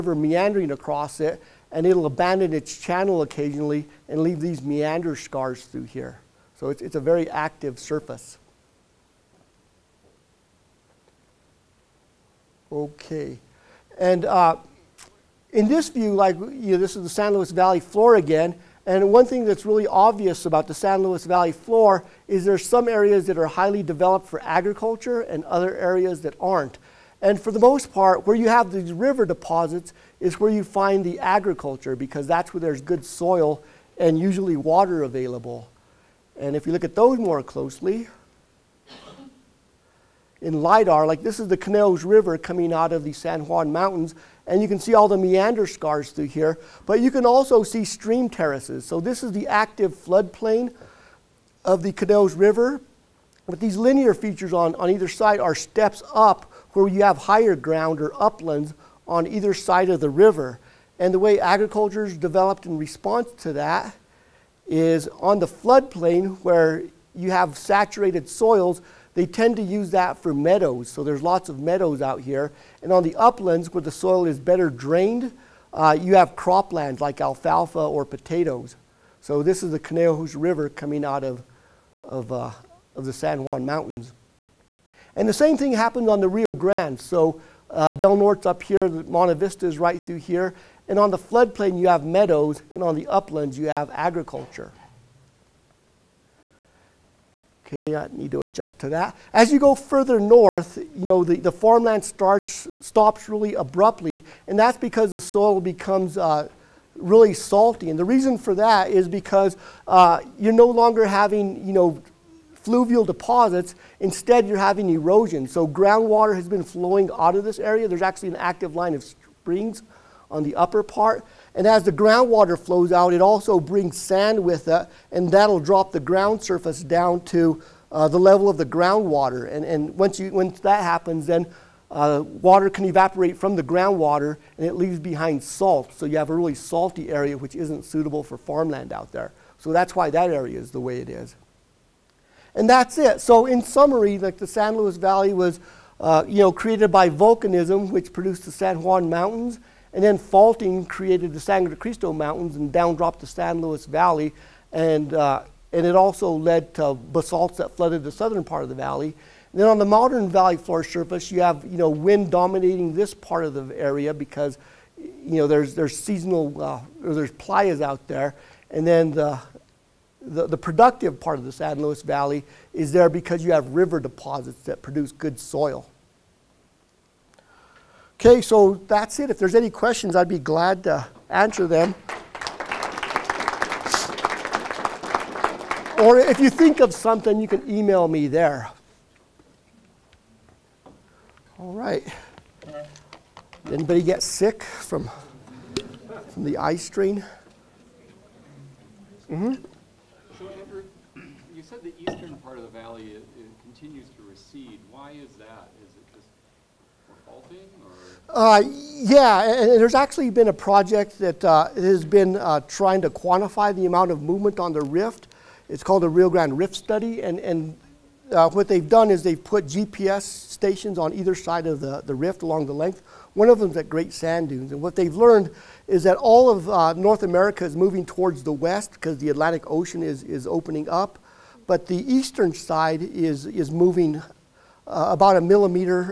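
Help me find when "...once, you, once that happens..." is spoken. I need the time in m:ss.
2:09.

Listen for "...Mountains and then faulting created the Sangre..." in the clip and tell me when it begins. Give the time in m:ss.
2:29.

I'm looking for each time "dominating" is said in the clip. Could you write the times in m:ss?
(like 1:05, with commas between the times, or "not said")
2:42.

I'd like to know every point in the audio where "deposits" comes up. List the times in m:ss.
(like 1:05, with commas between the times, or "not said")
0:29, 1:53, 2:53.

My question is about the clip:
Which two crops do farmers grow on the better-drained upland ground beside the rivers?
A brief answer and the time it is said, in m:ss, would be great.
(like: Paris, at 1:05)
alfalfa or potatoes, at 1:17.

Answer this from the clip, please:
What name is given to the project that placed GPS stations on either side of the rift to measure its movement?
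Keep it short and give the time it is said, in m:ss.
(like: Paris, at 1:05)
Rio Grande Rift Study, at 3:36.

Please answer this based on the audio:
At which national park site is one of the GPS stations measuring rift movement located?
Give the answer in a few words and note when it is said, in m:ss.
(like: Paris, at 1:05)
Great Sand Dunes, at 3:43.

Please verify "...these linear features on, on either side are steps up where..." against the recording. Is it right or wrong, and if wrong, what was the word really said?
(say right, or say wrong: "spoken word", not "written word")
right.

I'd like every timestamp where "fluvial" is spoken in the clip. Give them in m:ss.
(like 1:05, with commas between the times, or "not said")
1:52.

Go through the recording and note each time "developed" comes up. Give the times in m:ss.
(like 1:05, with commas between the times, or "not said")
0:23, 1:02.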